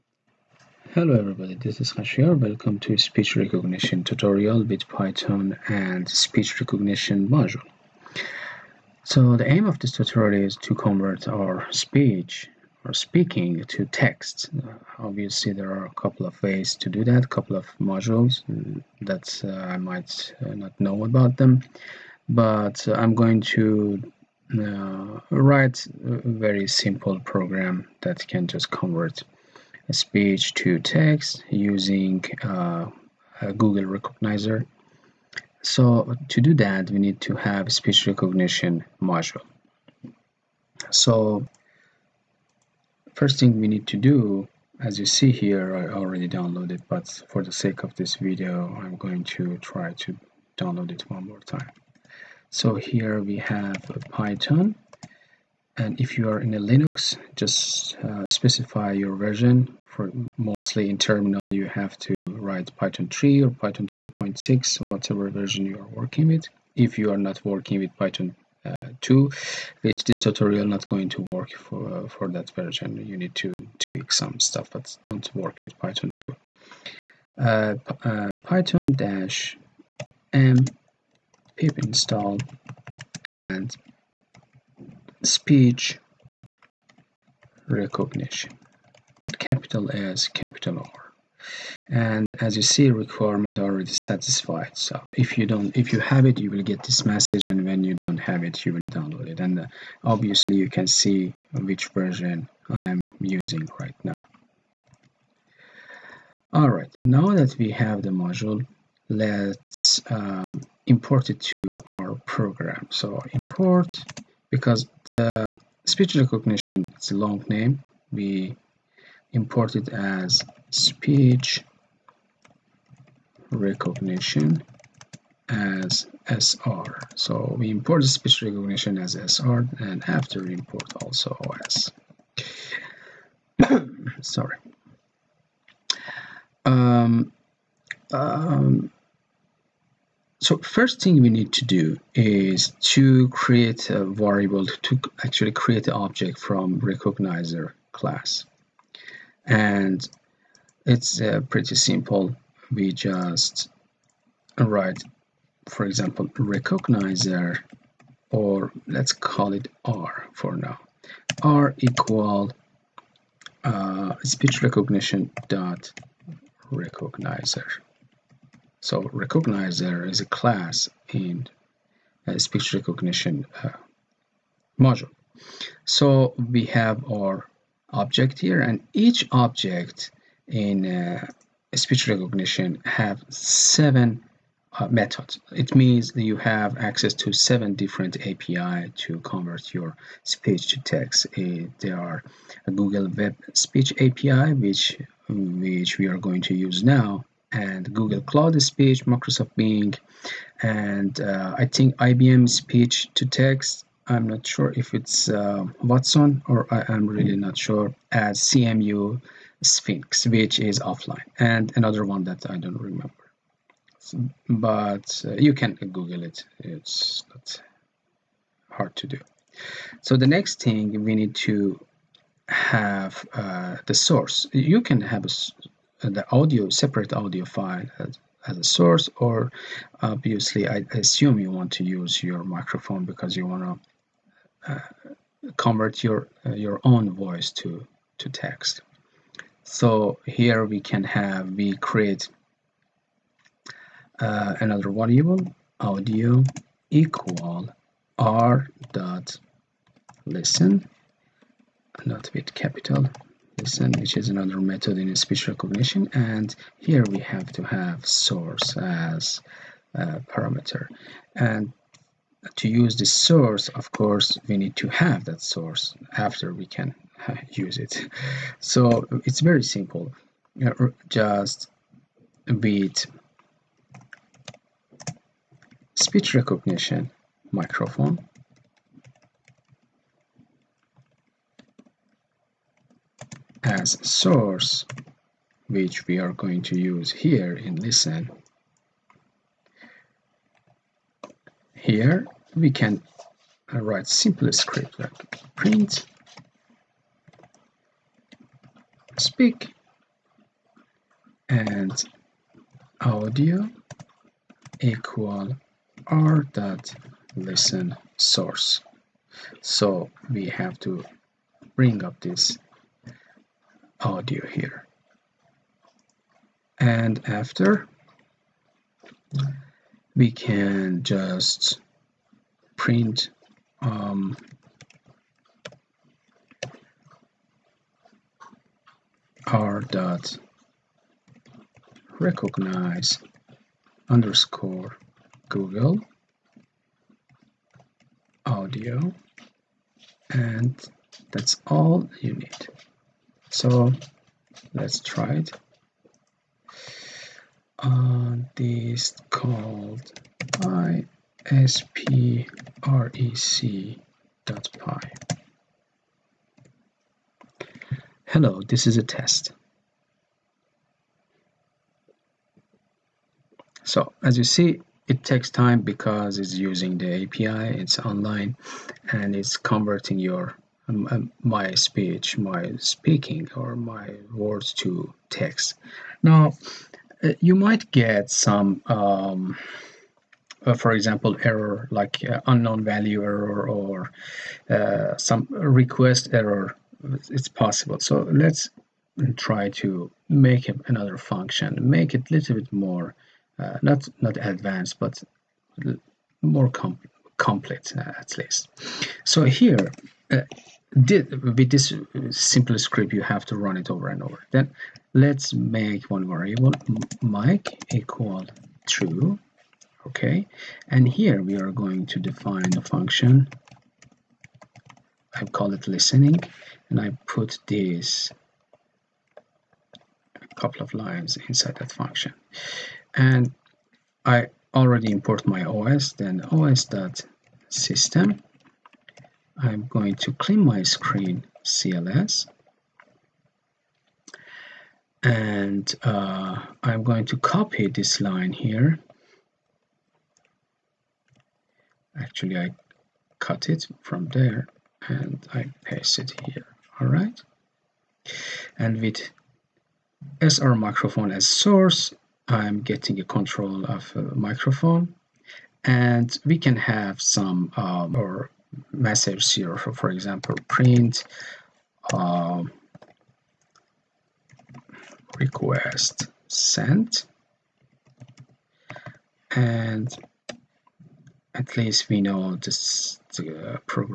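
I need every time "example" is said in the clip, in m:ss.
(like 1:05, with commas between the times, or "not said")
2:35, 6:20, 7:40.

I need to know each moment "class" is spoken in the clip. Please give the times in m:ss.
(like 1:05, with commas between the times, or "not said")
2:27, 2:50.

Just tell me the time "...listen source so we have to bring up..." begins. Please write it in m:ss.
5:07.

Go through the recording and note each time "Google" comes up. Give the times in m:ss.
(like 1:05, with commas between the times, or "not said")
0:33, 3:12, 3:17, 3:35, 5:35.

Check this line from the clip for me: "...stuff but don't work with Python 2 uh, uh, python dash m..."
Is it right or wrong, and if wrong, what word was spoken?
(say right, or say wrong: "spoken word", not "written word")
right.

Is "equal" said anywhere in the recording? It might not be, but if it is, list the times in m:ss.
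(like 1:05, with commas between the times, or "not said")
2:41, 4:06, 5:04, 6:47.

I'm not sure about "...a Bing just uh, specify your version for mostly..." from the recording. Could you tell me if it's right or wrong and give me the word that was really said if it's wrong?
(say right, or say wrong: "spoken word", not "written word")
wrong: "Linux", not "Bing".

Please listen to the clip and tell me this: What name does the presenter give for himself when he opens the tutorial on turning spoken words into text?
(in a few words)
Khashiyar.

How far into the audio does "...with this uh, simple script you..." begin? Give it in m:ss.
6:40.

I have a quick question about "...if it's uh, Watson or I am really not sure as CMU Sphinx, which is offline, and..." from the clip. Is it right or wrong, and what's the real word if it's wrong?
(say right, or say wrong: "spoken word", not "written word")
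right.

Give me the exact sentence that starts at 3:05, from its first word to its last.
It means you have access to seven different API to convert your speech to text.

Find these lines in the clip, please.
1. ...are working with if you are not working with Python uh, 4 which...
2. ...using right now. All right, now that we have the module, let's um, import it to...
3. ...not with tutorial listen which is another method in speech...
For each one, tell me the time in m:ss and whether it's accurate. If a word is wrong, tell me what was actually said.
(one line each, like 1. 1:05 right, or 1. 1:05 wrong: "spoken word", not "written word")
1. 1:05 wrong: "2", not "4"
2. 1:43 right
3. 4:12 wrong: "capital", not "tutorial".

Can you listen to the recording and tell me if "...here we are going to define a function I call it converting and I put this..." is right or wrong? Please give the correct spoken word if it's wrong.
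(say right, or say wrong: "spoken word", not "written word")
wrong: "listening", not "converting".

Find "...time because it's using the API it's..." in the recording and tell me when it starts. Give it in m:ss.
6:05.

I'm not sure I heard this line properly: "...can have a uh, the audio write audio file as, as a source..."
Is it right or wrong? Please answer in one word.
wrong.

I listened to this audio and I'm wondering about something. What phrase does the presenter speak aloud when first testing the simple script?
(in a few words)
hello this is a test.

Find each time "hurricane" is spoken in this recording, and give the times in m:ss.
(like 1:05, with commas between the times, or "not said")
not said.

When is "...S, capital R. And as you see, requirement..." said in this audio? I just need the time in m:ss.
1:29.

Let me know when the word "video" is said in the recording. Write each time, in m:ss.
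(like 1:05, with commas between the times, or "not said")
0:48.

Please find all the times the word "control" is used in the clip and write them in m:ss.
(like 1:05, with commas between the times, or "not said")
7:33.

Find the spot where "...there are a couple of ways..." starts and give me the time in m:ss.
0:15.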